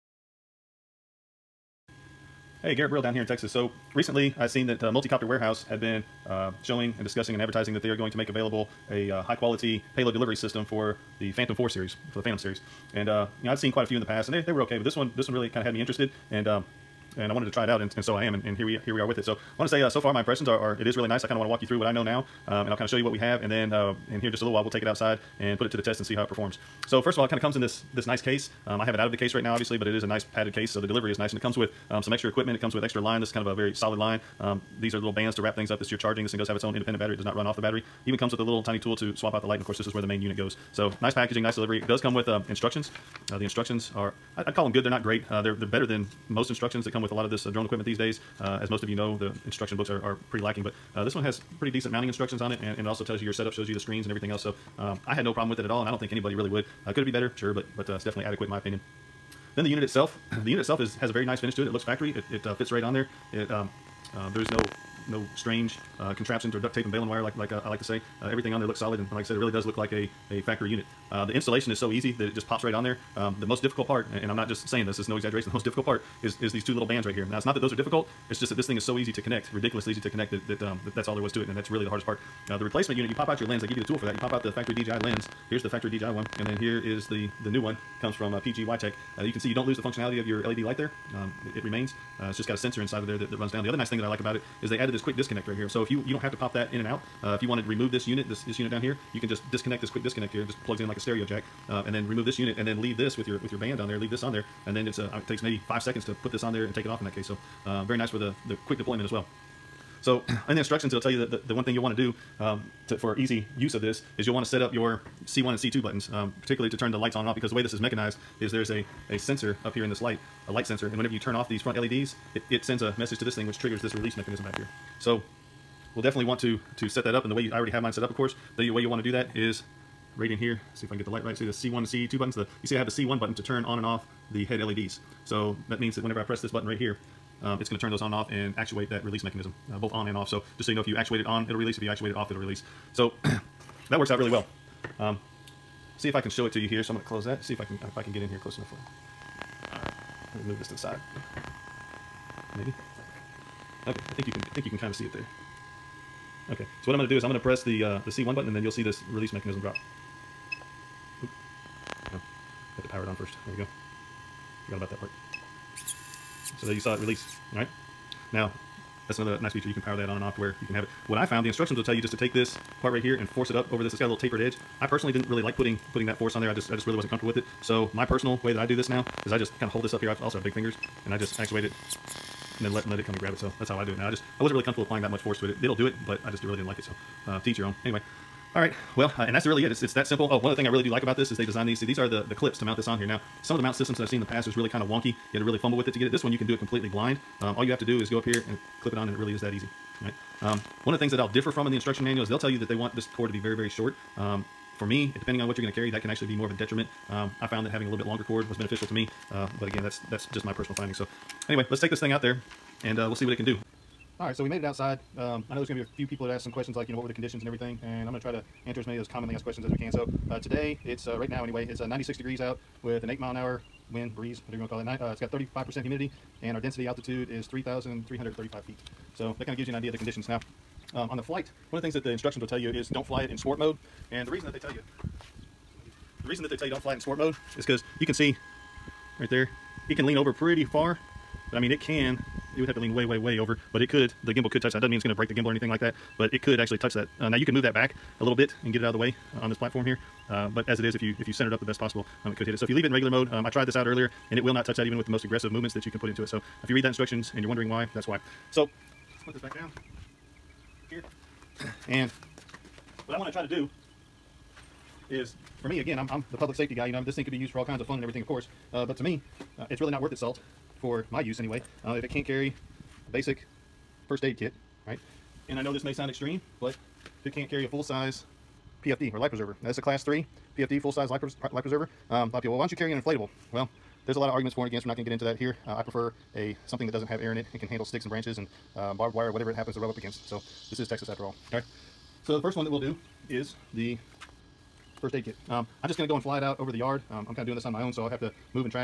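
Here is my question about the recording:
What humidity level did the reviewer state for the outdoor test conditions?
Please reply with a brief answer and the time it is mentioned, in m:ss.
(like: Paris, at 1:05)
35%, at 3:45.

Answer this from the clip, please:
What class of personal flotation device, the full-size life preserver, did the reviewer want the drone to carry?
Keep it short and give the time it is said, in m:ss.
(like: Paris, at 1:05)
Class 3, at 4:39.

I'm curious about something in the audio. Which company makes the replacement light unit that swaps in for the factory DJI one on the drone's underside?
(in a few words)
PGYTECH.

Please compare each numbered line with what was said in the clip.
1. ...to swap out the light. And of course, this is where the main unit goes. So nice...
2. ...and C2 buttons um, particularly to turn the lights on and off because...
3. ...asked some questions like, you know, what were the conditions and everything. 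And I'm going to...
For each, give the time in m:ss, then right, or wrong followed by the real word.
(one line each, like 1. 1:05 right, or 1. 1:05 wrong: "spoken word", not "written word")
1. 0:38 right
2. 1:55 right
3. 3:36 right.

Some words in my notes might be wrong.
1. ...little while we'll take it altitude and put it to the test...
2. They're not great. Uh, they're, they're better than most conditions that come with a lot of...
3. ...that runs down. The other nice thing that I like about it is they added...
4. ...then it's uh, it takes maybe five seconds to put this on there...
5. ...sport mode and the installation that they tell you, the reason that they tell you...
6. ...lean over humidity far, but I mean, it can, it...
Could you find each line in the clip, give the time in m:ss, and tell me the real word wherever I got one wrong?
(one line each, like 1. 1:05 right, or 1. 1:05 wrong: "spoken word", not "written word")
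1. 0:24 wrong: "outside", not "altitude"
2. 0:44 wrong: "instructions", not "conditions"
3. 1:33 right
4. 1:44 right
5. 3:53 wrong: "reason", not "installation"
6. 4:00 wrong: "pretty", not "humidity".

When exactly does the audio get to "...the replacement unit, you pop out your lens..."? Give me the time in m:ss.
1:22.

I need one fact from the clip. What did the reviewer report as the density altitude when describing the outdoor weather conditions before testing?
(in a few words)
3,335 feet.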